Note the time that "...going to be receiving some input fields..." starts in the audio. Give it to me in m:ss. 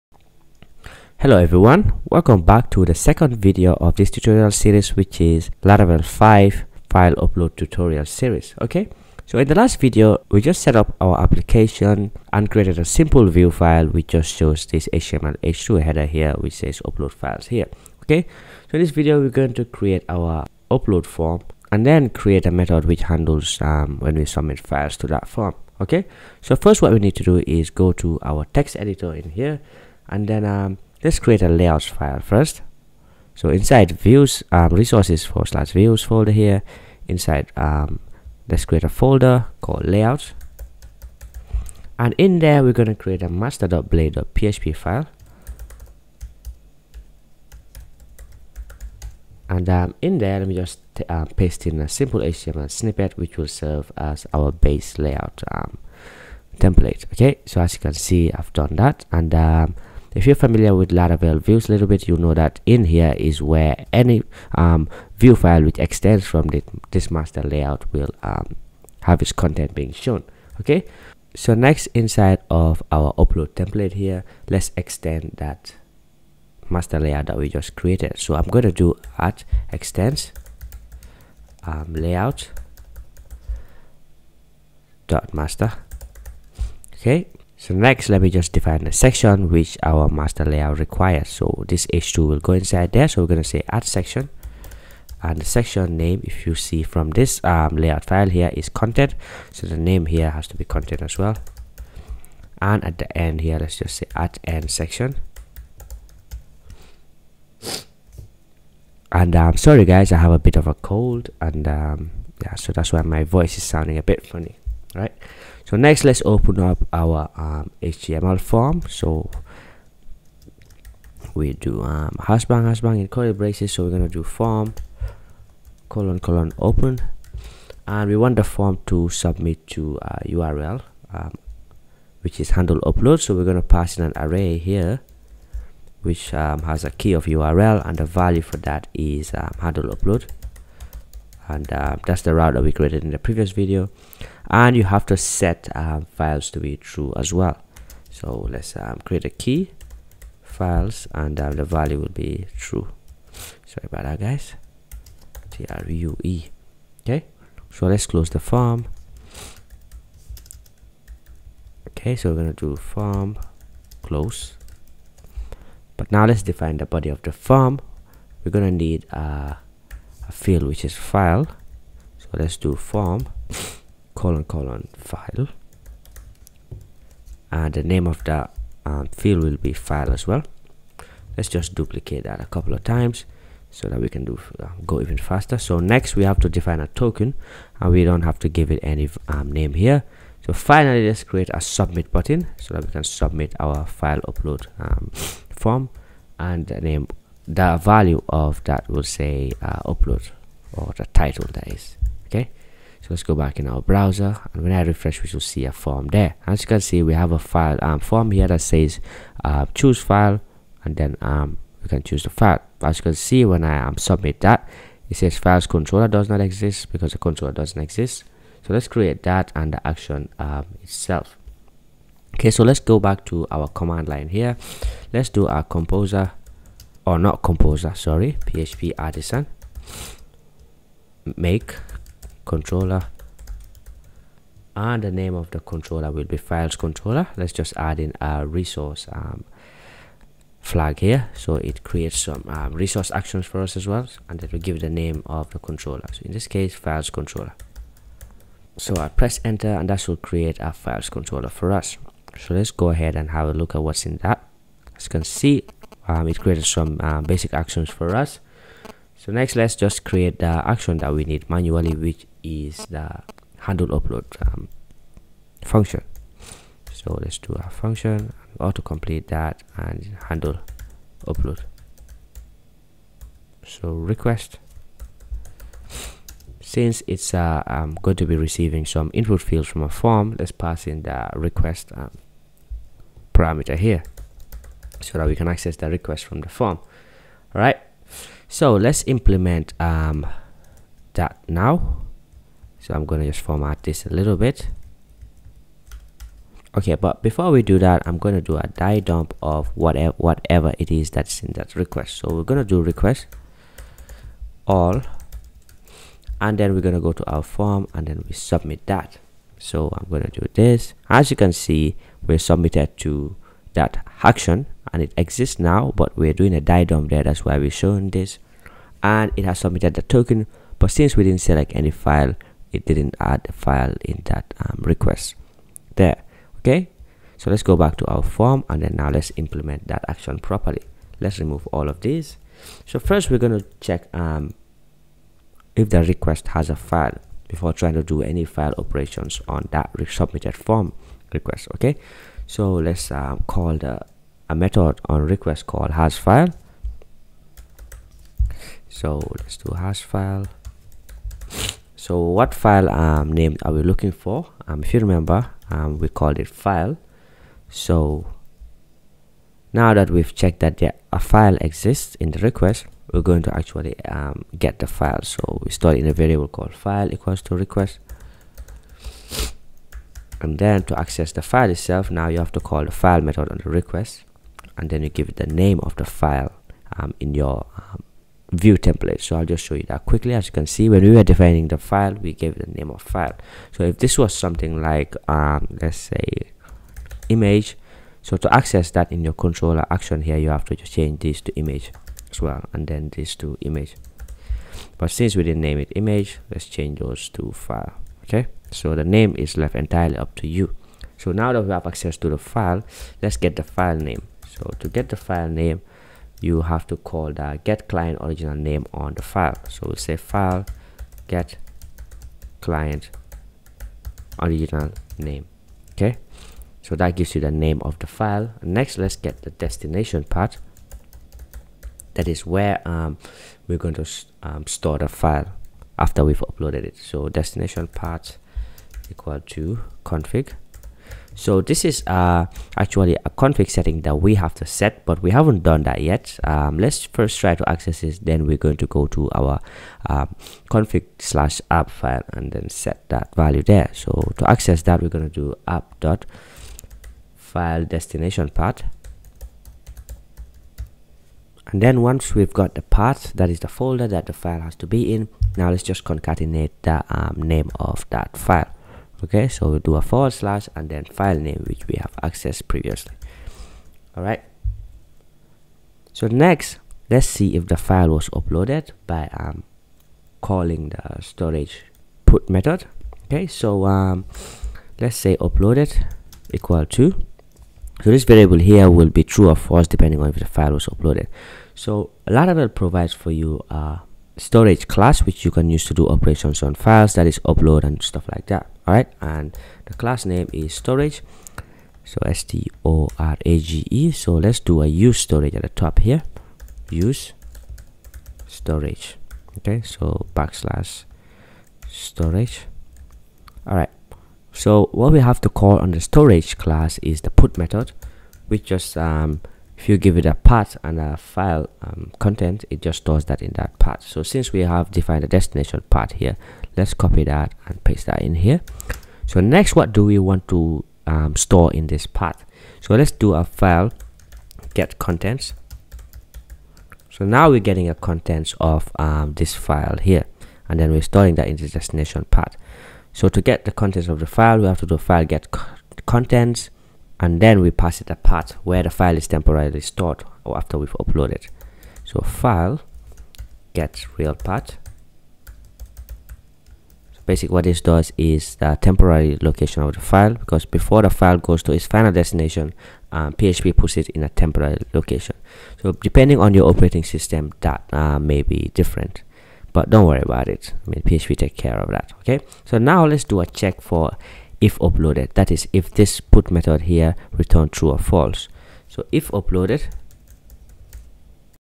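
4:38.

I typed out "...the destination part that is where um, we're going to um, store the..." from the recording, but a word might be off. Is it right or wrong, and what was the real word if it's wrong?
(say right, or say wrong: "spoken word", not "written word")
right.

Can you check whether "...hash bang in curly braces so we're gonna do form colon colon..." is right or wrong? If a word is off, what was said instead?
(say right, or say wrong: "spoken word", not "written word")
right.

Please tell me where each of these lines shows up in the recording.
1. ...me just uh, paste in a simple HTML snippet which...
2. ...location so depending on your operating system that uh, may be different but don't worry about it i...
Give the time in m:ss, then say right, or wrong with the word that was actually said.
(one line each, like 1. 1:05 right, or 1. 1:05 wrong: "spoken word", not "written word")
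1. 0:50 right
2. 9:14 right.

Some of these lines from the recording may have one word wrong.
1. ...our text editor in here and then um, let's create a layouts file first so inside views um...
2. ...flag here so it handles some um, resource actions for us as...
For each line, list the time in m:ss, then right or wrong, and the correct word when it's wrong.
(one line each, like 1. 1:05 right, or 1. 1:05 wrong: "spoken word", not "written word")
1. 0:28 right
2. 4:00 wrong: "creates", not "handles".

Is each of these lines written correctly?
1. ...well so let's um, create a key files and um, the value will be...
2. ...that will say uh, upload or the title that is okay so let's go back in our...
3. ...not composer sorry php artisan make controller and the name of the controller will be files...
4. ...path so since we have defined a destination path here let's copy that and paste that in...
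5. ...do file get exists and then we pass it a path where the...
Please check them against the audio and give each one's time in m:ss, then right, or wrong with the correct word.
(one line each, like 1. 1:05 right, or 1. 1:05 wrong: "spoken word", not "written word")
1. 2:27 right
2. 3:18 right
3. 3:47 right
4. 8:33 right
5. 8:54 wrong: "contents", not "exists".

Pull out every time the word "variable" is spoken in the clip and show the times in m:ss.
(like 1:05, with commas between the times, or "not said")
6:06, 7:58.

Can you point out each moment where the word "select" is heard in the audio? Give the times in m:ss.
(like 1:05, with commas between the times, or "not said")
5:21.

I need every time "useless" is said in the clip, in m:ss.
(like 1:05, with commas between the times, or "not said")
not said.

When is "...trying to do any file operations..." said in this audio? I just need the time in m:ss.
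5:37.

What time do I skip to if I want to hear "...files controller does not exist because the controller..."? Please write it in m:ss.
3:35.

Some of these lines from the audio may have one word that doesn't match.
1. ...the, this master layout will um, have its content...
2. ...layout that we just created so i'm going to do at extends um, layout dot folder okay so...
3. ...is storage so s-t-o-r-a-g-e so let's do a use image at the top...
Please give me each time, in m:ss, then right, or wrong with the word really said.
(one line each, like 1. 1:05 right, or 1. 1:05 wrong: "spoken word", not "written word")
1. 1:06 right
2. 1:16 wrong: "master", not "folder"
3. 8:10 wrong: "storage", not "image".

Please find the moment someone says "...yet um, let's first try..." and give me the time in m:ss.
7:16.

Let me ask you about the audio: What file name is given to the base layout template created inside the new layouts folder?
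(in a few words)
master.blade.php.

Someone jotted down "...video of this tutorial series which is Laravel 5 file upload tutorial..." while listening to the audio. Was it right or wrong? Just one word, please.
right.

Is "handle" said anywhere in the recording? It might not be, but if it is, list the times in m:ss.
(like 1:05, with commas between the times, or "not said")
0:23, 2:12, 2:19, 4:23, 4:30.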